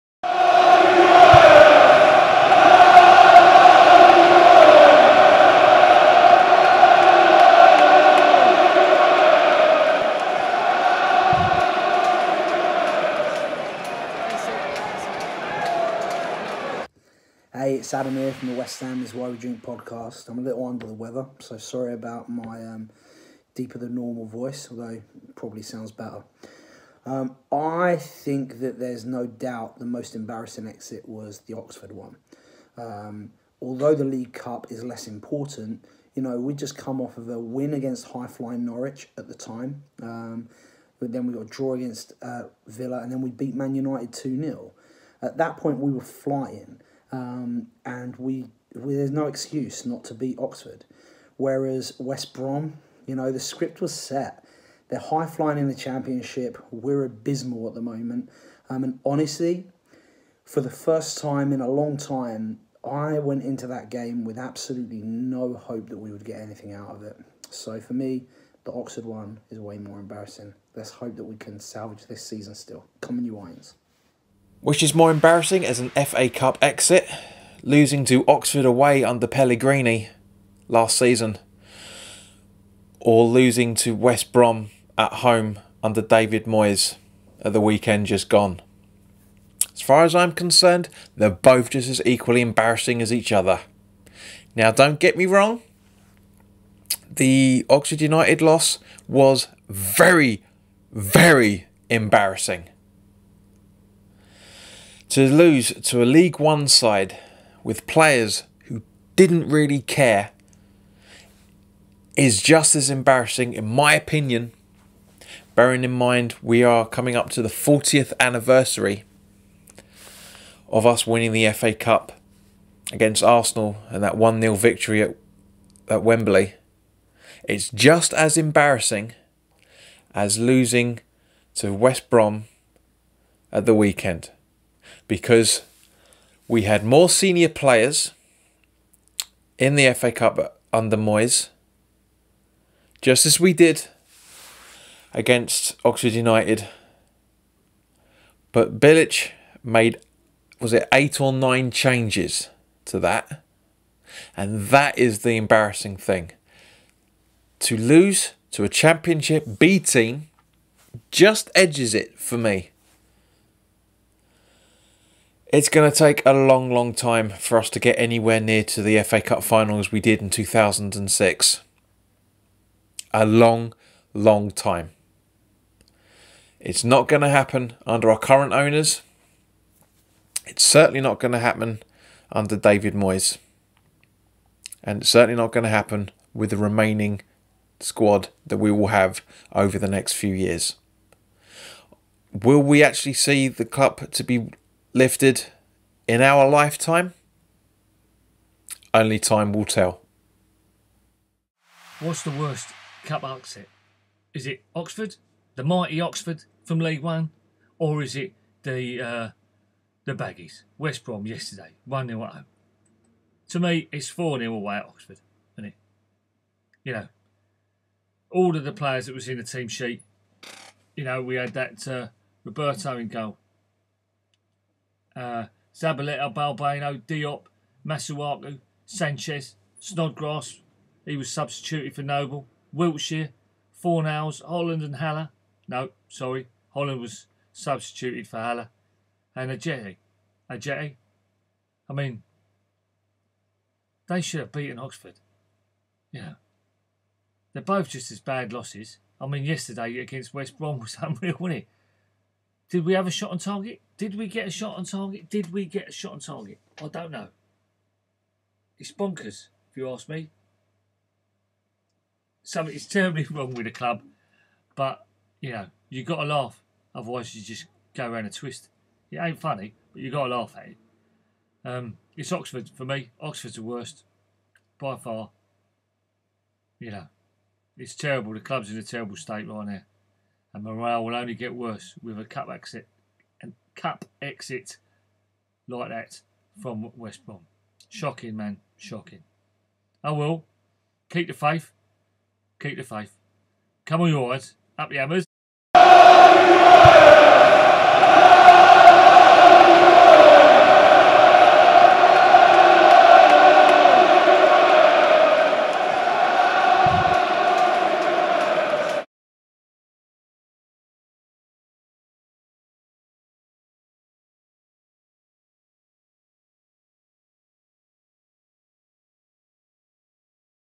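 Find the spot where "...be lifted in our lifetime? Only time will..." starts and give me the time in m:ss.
3:14.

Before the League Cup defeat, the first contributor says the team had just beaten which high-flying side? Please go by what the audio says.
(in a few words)
Norwich.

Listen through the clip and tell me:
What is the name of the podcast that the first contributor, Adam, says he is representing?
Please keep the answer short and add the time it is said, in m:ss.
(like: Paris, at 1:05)
West Ham is Why We Drink, at 0:18.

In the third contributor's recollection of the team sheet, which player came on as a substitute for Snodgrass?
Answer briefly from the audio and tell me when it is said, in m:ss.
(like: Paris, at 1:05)
Noble, at 3:52.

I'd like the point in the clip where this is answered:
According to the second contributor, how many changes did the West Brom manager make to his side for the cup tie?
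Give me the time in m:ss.
2:30.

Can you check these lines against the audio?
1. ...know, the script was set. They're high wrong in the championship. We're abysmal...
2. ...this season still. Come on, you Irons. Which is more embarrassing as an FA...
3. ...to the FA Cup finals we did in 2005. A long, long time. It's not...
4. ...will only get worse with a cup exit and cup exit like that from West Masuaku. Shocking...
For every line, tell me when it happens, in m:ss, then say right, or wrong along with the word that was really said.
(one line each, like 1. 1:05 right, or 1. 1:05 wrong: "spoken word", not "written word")
1. 0:53 wrong: "flying", not "wrong"
2. 1:12 right
3. 2:48 wrong: "2006", not "2005"
4. 4:41 wrong: "Brom", not "Masuaku".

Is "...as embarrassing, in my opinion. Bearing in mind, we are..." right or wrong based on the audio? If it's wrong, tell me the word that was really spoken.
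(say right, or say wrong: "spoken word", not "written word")
right.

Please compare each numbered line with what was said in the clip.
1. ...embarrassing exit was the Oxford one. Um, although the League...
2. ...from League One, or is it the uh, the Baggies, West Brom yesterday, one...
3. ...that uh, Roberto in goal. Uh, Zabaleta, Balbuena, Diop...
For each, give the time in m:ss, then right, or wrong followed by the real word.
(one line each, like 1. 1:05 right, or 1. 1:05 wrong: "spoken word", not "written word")
1. 0:30 right
2. 3:26 right
3. 3:41 right.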